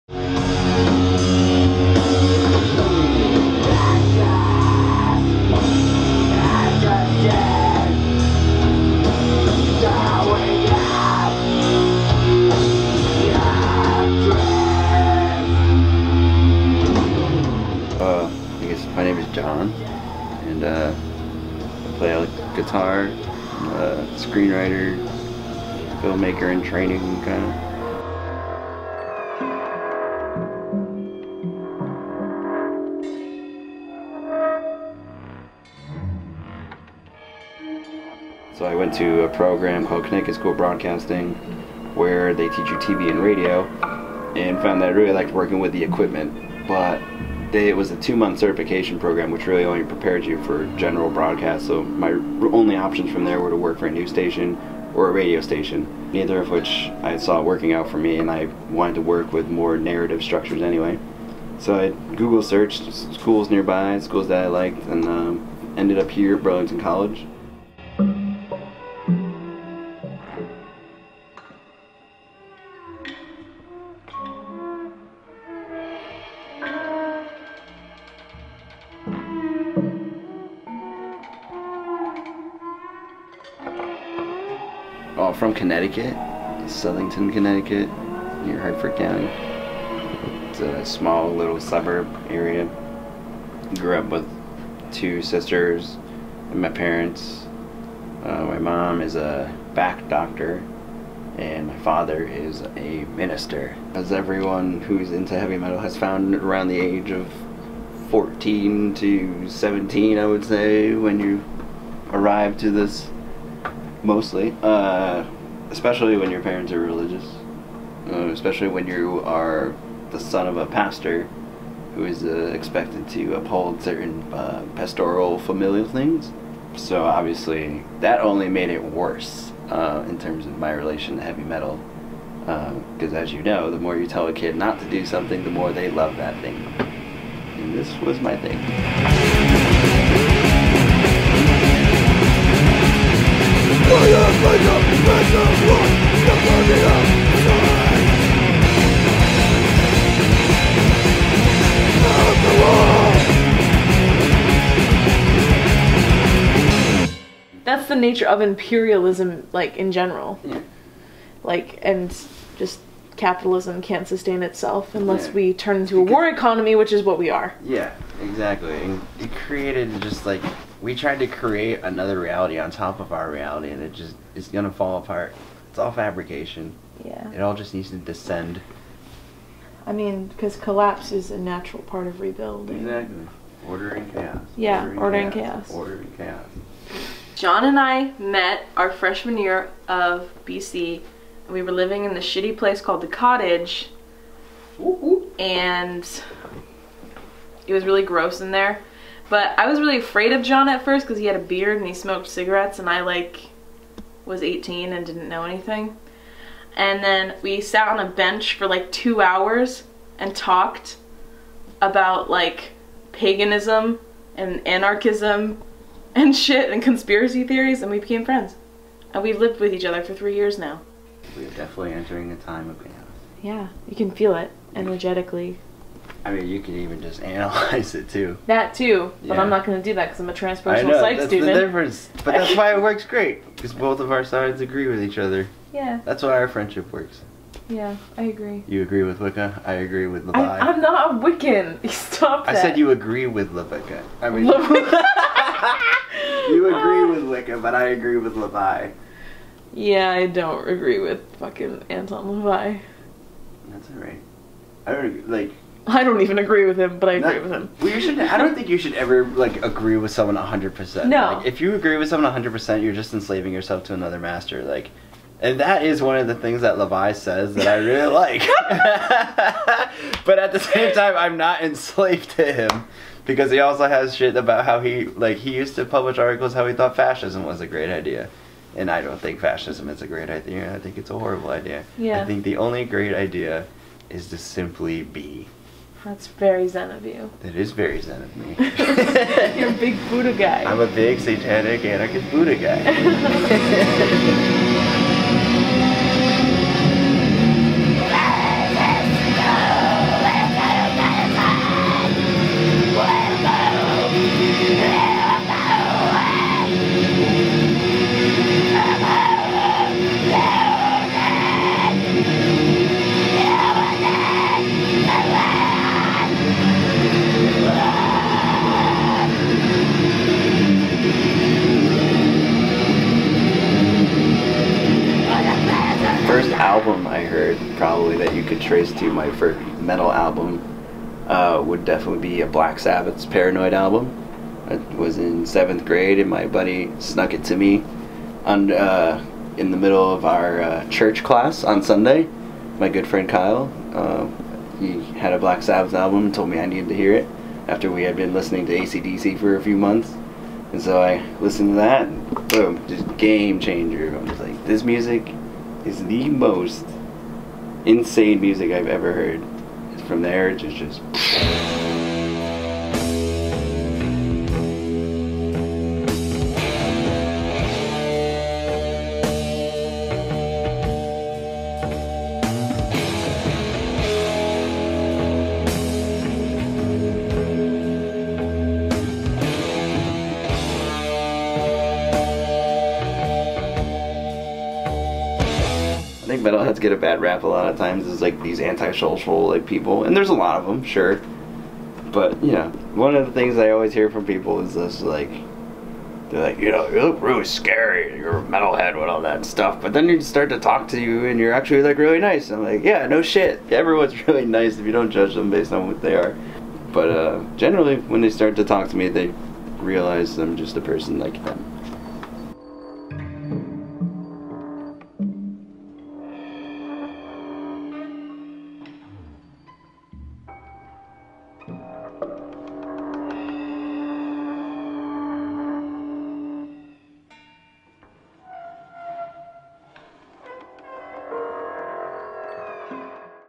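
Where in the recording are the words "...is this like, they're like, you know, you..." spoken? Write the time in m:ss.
6:34.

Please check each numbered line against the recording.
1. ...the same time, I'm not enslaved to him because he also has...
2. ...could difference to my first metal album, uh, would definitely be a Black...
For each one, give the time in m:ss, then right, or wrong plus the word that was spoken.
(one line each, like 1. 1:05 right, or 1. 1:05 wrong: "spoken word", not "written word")
1. 4:30 right
2. 5:28 wrong: "trace", not "difference".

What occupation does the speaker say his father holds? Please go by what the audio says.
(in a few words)
minister.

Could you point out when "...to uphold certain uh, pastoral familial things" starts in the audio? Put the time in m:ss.
2:03.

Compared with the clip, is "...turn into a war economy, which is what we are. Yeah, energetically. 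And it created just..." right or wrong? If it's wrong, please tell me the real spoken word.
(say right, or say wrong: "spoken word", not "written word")
wrong: "exactly", not "energetically".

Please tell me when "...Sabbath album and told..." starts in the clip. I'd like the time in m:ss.
5:45.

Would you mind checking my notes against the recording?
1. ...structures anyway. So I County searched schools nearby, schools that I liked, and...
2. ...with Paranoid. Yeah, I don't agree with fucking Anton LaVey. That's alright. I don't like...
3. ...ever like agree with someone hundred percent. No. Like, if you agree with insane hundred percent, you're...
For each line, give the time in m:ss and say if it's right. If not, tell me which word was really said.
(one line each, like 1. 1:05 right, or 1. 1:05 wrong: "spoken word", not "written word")
1. 1:00 wrong: "Google", not "County"
2. 4:08 wrong: "LaVey", not "Paranoid"
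3. 4:18 wrong: "someone", not "insane".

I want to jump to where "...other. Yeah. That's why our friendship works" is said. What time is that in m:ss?
3:55.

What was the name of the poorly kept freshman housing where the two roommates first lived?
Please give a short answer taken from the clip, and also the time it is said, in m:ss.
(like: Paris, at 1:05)
the Cottage, at 3:13.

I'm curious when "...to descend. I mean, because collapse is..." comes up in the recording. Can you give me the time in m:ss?
2:57.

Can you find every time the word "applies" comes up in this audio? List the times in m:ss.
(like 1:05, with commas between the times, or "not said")
not said.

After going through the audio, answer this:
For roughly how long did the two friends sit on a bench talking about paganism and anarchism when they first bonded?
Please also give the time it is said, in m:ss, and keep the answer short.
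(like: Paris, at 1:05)
2 hours, at 3:28.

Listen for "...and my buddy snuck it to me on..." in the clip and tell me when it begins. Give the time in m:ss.
5:36.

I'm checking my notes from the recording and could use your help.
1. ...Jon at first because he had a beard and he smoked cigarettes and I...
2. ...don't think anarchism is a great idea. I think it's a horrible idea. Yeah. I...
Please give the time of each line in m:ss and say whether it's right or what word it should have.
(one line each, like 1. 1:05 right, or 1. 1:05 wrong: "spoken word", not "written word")
1. 3:20 right
2. 4:39 wrong: "fascism", not "anarchism".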